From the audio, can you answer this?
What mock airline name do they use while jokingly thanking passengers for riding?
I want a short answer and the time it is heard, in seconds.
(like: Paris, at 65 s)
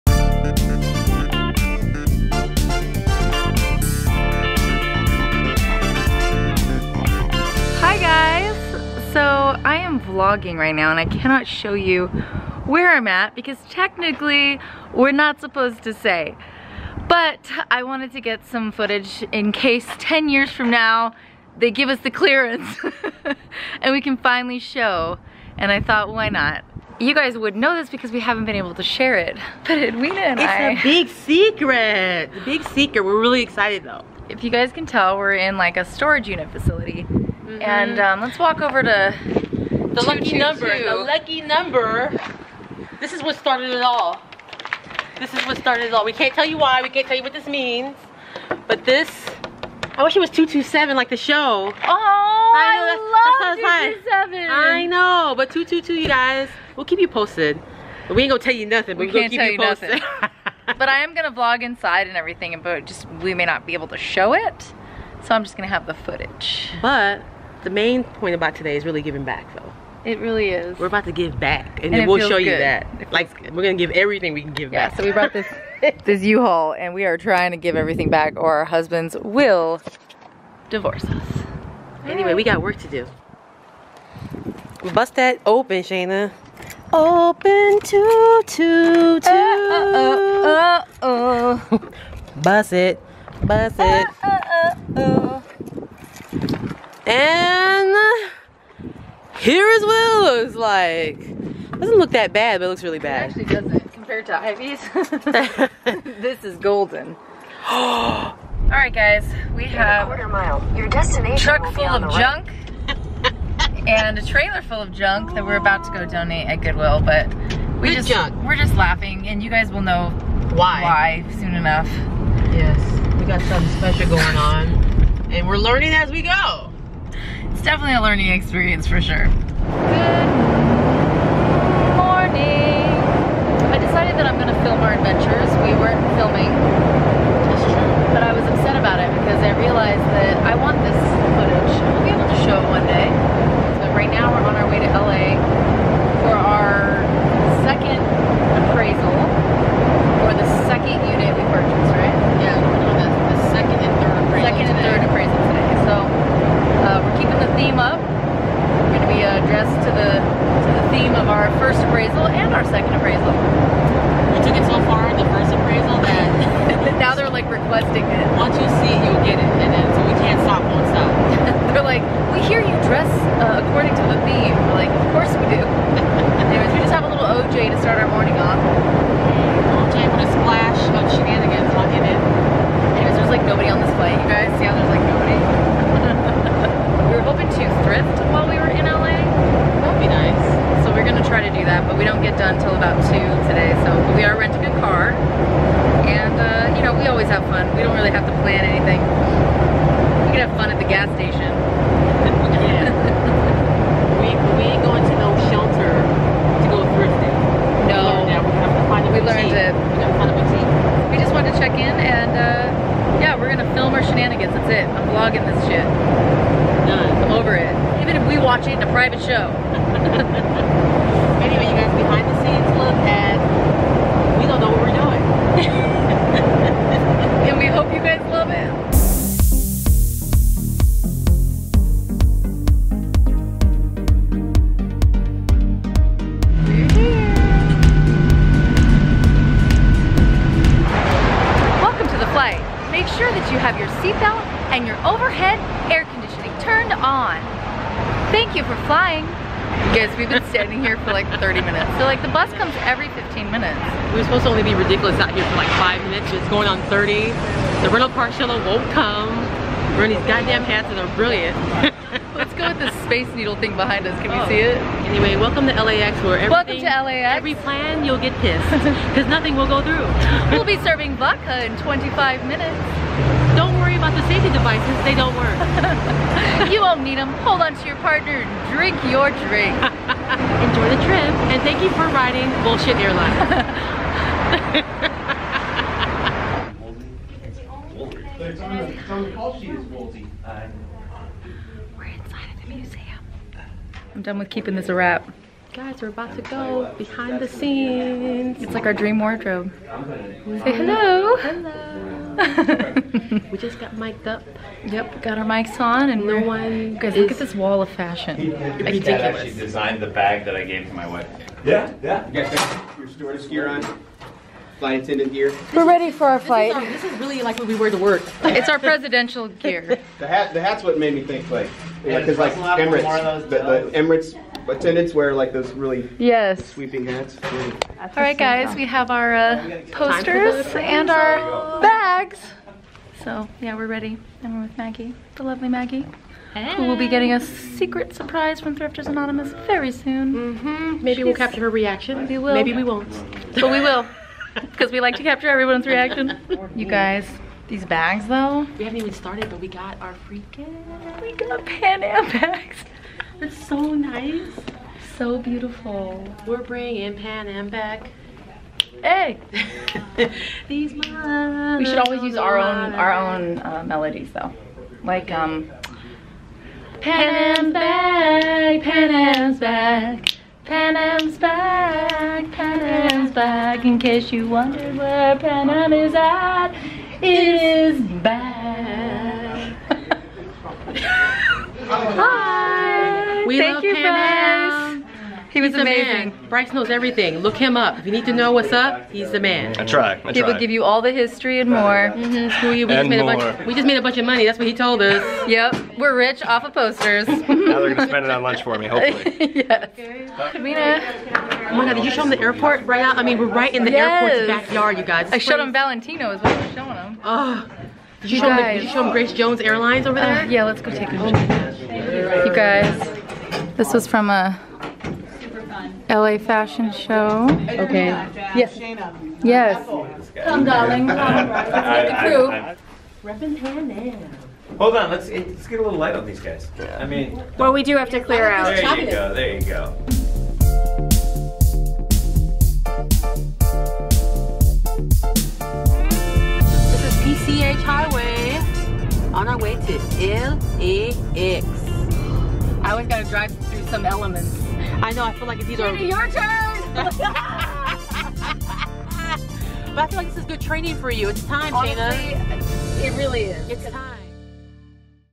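Bullshit Airline, at 282 s.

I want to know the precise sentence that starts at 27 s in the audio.
You guys would know this because we haven't been able to share it.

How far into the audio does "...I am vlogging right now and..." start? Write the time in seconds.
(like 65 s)
9 s.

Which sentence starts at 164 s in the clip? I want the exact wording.
We took it so far in the first appraisal that...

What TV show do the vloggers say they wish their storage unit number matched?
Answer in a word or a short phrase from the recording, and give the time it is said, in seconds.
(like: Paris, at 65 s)
227, at 50 s.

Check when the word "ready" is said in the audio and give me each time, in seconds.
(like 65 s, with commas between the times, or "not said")
315 s, 333 s.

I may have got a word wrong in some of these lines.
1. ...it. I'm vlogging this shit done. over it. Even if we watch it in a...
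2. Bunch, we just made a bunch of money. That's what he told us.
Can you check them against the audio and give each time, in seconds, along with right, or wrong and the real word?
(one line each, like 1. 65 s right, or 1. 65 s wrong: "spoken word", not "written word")
1. 214 s right
2. 393 s right.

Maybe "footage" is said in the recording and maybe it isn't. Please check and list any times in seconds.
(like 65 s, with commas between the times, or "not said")
18 s, 65 s, 141 s.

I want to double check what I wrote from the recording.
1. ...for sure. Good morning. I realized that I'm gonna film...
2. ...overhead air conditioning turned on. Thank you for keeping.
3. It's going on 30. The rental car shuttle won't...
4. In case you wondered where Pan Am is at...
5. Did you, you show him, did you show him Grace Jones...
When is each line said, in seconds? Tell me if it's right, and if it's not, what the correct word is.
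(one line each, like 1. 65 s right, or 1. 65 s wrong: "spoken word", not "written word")
1. 128 s wrong: "decided", not "realized"
2. 245 s wrong: "flying", not "keeping"
3. 256 s right
4. 373 s right
5. 407 s right.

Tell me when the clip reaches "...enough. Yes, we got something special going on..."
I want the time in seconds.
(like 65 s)
121 s.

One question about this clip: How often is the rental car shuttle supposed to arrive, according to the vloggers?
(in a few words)
Every 15 minutes.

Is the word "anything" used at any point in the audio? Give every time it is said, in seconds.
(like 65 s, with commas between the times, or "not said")
198 s.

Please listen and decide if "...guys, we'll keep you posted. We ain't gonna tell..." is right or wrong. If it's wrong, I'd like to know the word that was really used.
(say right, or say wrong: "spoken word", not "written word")
right.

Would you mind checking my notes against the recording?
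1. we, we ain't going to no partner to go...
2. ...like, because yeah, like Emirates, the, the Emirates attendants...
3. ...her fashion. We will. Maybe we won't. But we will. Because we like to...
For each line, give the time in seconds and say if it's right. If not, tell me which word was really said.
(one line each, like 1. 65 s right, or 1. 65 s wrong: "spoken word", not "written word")
1. 204 s wrong: "shelter", not "partner"
2. 321 s right
3. 341 s wrong: "reaction", not "fashion".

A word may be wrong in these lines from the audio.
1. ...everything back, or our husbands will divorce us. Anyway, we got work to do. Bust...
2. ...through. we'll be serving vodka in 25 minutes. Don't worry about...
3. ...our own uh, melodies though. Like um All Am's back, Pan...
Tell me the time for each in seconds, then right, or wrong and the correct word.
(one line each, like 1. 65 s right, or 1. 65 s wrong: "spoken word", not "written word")
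1. 77 s right
2. 269 s right
3. 362 s wrong: "Pan", not "All".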